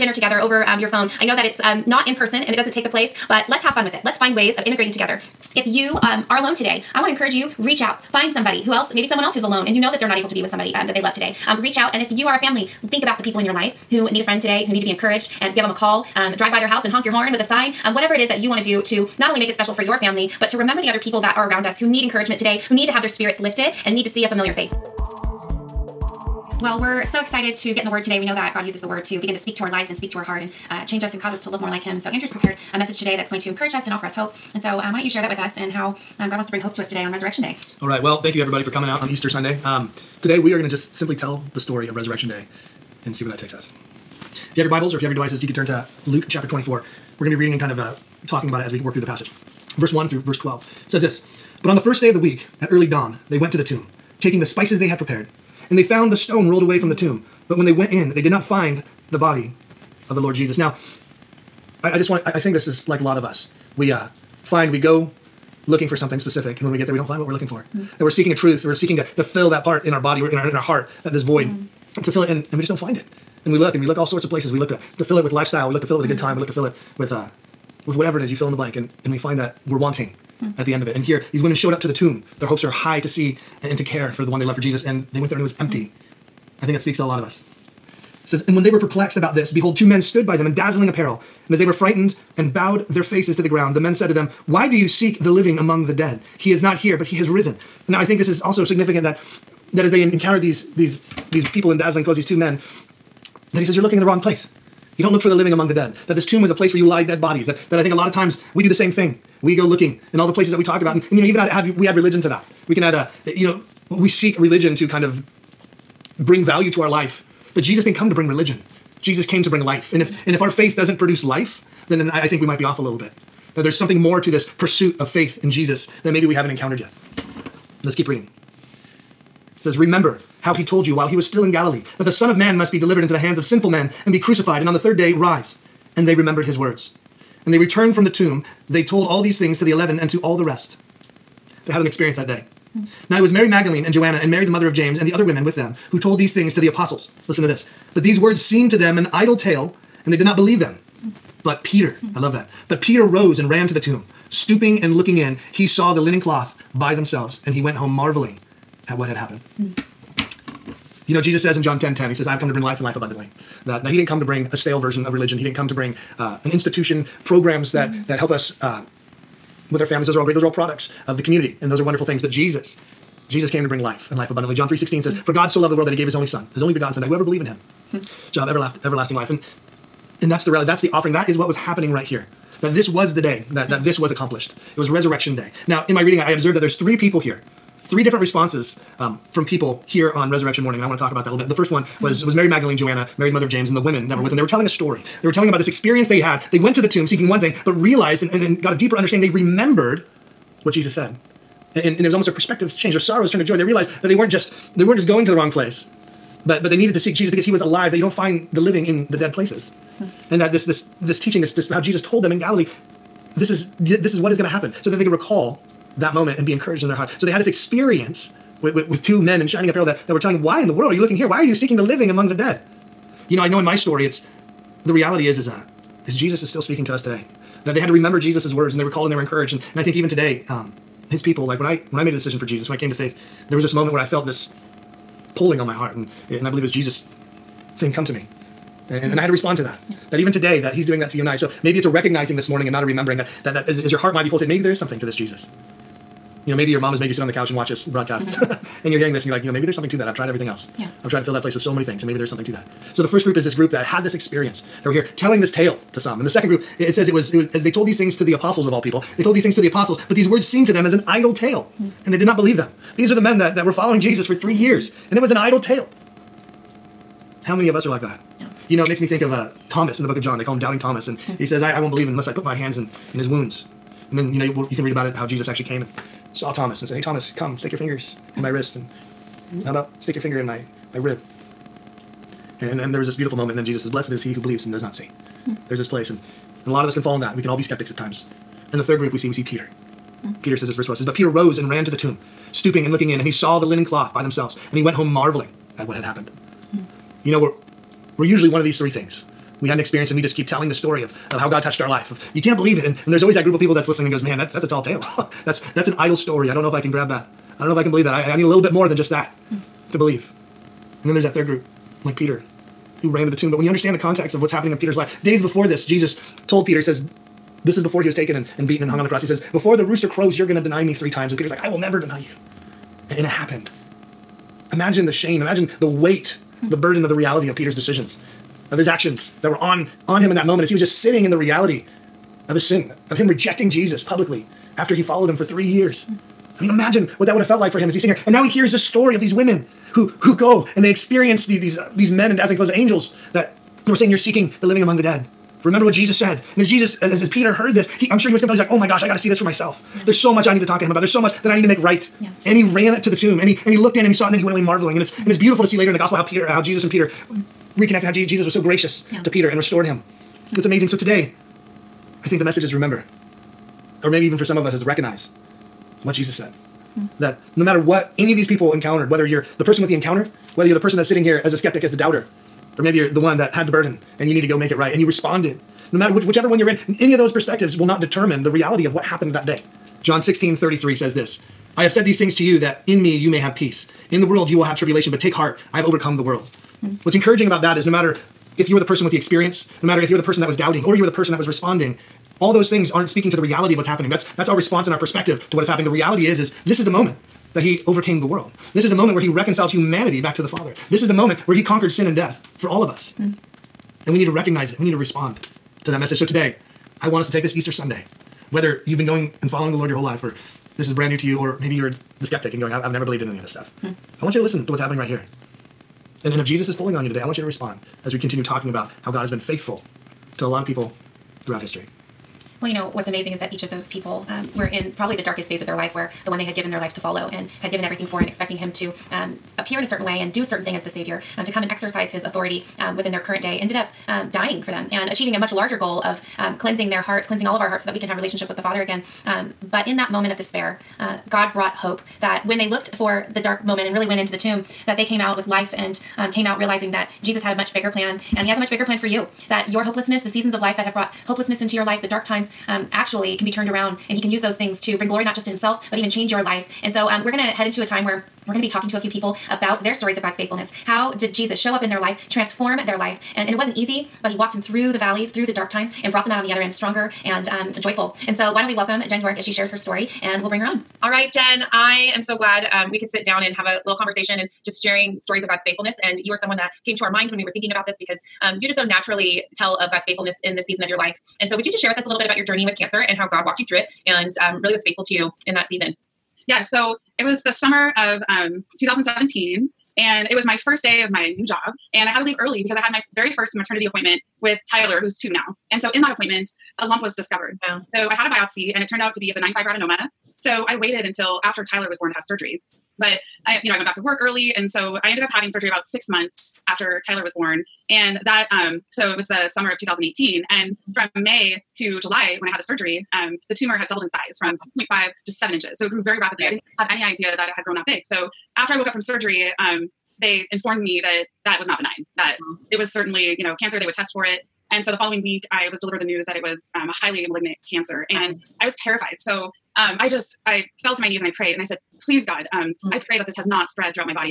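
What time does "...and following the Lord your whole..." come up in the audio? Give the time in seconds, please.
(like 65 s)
409 s.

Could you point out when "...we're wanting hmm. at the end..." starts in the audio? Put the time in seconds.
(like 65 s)
79 s.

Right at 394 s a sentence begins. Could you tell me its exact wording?
That's that's our response and our perspective to what is happening.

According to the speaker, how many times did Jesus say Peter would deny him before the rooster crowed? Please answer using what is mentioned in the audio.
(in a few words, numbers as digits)
3.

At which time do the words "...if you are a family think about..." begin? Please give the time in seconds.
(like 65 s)
12 s.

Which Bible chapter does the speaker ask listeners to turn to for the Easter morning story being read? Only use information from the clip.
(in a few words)
Luke 24.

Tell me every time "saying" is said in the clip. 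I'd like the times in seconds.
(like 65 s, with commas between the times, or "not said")
237 s, 343 s.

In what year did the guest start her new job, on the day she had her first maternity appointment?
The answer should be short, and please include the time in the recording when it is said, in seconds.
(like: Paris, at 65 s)
2017, at 488 s.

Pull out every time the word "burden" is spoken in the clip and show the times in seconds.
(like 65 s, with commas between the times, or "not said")
326 s, 373 s.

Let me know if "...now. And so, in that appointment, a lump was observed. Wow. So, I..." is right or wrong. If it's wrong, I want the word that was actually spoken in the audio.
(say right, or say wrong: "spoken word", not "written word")
wrong: "discovered", not "observed".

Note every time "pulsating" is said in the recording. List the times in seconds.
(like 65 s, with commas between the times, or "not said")
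244 s.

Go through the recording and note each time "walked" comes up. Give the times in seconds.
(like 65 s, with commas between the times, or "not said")
464 s, 483 s.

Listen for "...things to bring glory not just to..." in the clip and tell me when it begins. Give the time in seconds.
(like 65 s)
454 s.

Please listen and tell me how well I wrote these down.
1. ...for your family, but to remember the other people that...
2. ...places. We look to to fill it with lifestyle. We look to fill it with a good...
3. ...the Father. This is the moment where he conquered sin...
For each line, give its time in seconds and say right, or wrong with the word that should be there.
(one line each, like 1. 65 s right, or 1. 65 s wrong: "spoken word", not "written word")
1. 19 s right
2. 74 s right
3. 400 s right.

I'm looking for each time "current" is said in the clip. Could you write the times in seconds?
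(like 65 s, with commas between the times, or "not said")
433 s.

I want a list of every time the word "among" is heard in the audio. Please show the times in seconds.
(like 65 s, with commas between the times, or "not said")
95 s, 105 s, 222 s, 344 s.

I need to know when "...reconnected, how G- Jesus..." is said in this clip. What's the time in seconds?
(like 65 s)
357 s.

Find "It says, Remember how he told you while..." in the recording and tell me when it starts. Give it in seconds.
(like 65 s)
129 s.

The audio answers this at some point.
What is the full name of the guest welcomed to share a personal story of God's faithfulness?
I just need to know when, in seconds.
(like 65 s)
469 s.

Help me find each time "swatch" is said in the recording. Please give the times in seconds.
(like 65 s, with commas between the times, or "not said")
not said.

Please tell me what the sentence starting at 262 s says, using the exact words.
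These are the men that that were following Jesus for three years, and it was an idle tale.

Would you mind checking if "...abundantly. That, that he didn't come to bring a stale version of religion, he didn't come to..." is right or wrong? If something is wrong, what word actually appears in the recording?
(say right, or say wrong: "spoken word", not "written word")
right.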